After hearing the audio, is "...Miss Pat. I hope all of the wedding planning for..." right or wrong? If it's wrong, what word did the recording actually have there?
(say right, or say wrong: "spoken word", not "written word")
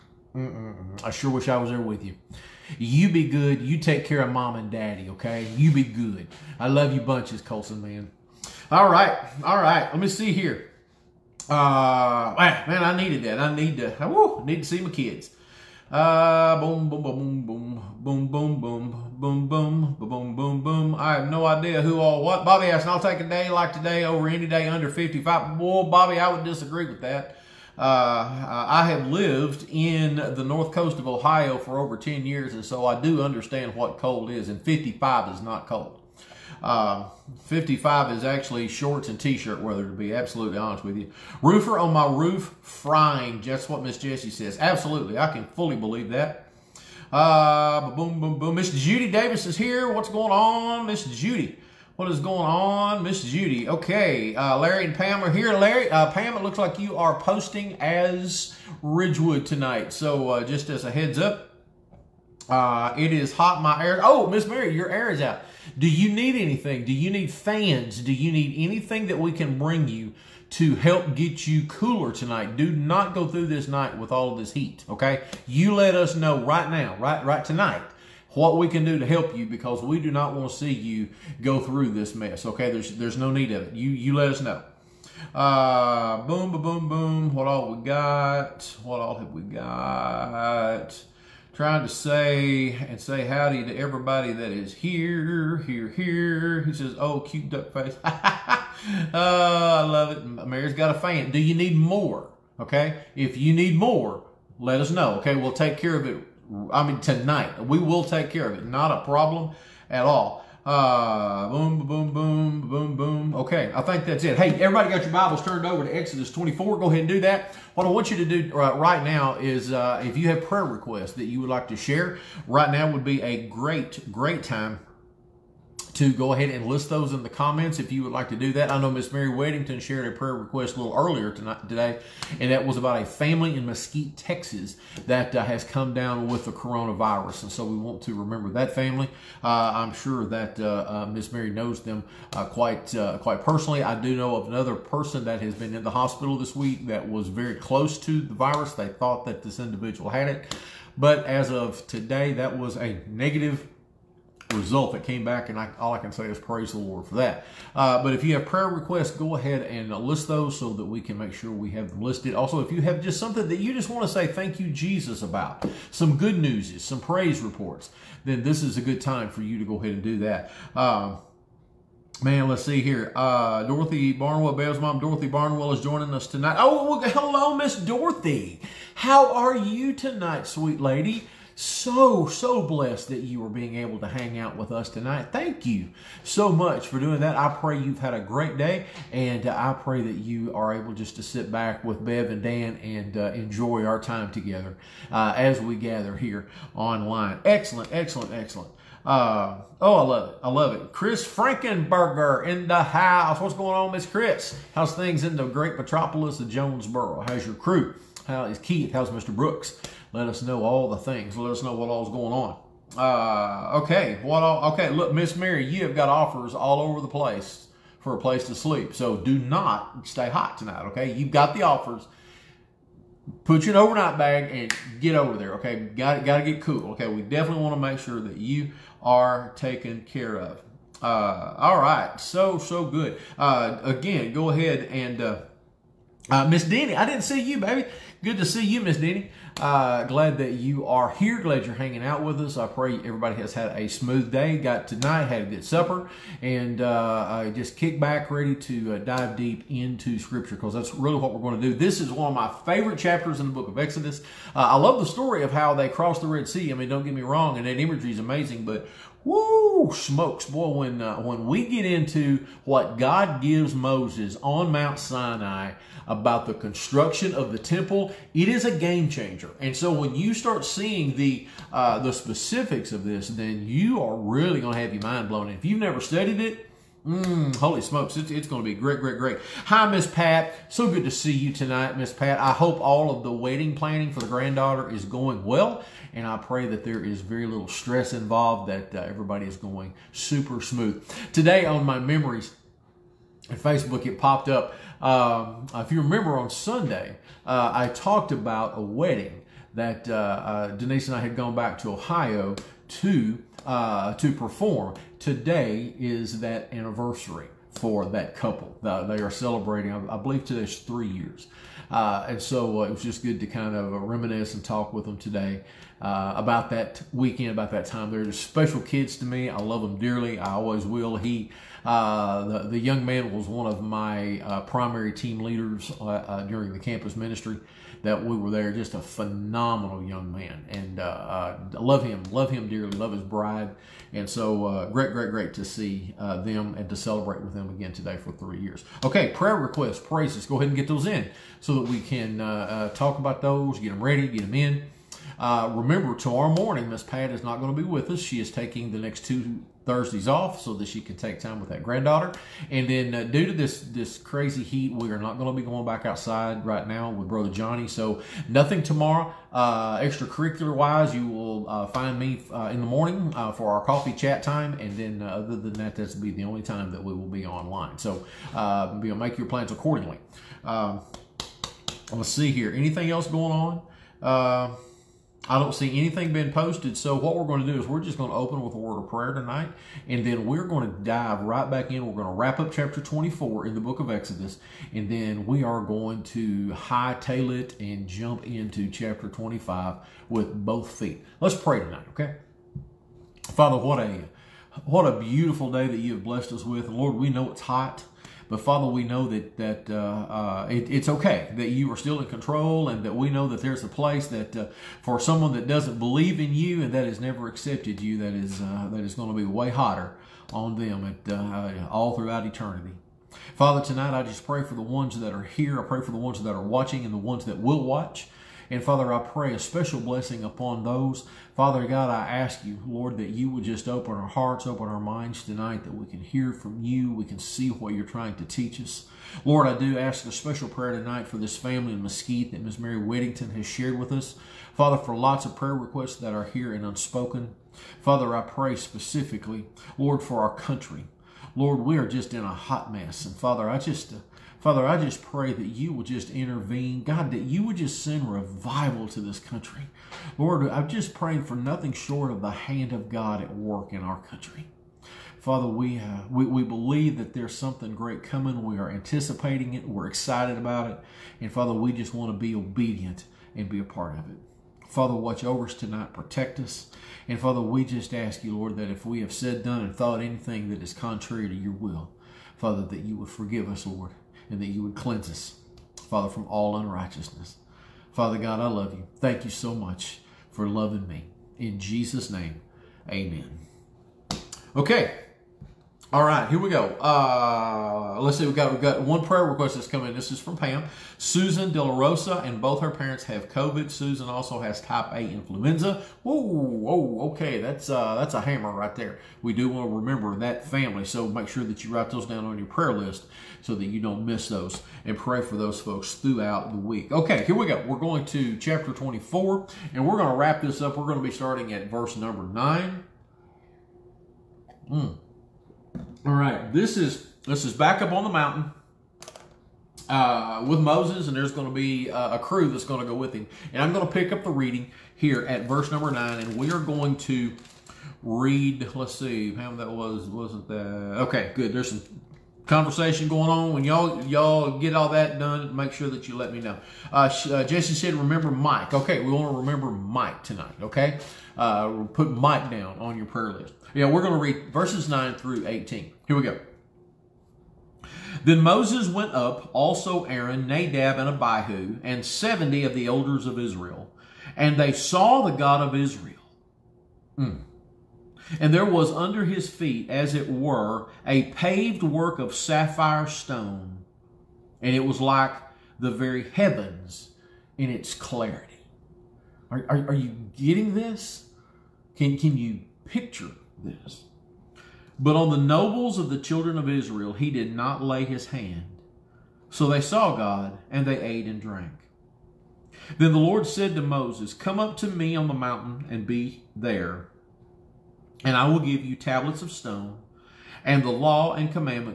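right.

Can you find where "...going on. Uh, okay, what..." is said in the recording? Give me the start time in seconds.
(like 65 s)
212 s.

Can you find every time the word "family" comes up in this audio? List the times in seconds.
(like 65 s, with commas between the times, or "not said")
133 s, 138 s, 431 s, 500 s.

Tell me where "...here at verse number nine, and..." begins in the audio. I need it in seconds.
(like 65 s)
525 s.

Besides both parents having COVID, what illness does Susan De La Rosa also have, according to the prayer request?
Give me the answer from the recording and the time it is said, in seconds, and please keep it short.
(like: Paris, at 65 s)
type A influenza, at 494 s.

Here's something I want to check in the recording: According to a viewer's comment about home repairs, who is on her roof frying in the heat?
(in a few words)
Roofer.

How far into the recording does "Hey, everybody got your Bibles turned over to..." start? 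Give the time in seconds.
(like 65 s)
114 s.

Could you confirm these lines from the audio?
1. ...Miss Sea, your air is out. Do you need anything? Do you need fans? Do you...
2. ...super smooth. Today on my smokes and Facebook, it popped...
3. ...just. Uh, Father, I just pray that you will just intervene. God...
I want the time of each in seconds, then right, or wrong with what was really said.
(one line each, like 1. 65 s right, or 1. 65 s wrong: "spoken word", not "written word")
1. 64 s wrong: "Mary", not "Sea"
2. 290 s wrong: "memories", not "smokes"
3. 443 s right.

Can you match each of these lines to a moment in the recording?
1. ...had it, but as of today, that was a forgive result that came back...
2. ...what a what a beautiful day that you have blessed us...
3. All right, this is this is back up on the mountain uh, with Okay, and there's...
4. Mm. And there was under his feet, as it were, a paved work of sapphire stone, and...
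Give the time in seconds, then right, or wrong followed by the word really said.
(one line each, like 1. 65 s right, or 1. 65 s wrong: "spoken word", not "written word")
1. 150 s wrong: "negative", not "forgive"
2. 393 s right
3. 516 s wrong: "Moses", not "Okay"
4. 557 s right.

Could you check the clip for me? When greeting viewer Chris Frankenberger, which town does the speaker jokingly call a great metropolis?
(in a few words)
Jonesboro.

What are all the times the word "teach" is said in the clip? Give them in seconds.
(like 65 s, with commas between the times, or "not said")
428 s.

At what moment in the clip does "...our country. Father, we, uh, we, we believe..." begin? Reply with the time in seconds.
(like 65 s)
454 s.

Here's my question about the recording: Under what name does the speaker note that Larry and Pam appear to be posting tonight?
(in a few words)
Ridgewood.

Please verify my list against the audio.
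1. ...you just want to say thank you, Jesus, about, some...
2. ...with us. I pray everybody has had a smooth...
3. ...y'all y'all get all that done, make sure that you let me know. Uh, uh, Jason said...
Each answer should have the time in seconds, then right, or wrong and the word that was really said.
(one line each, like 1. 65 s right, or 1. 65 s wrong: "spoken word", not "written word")
1. 163 s right
2. 242 s right
3. 533 s right.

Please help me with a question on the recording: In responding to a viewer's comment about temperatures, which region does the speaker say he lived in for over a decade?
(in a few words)
north coast of Ohio.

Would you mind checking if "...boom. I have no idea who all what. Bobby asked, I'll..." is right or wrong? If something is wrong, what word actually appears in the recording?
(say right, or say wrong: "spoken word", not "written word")
right.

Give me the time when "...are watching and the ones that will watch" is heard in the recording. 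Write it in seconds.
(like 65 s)
416 s.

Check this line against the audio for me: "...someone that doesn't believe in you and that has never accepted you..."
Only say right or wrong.
right.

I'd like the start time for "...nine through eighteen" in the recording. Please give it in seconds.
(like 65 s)
545 s.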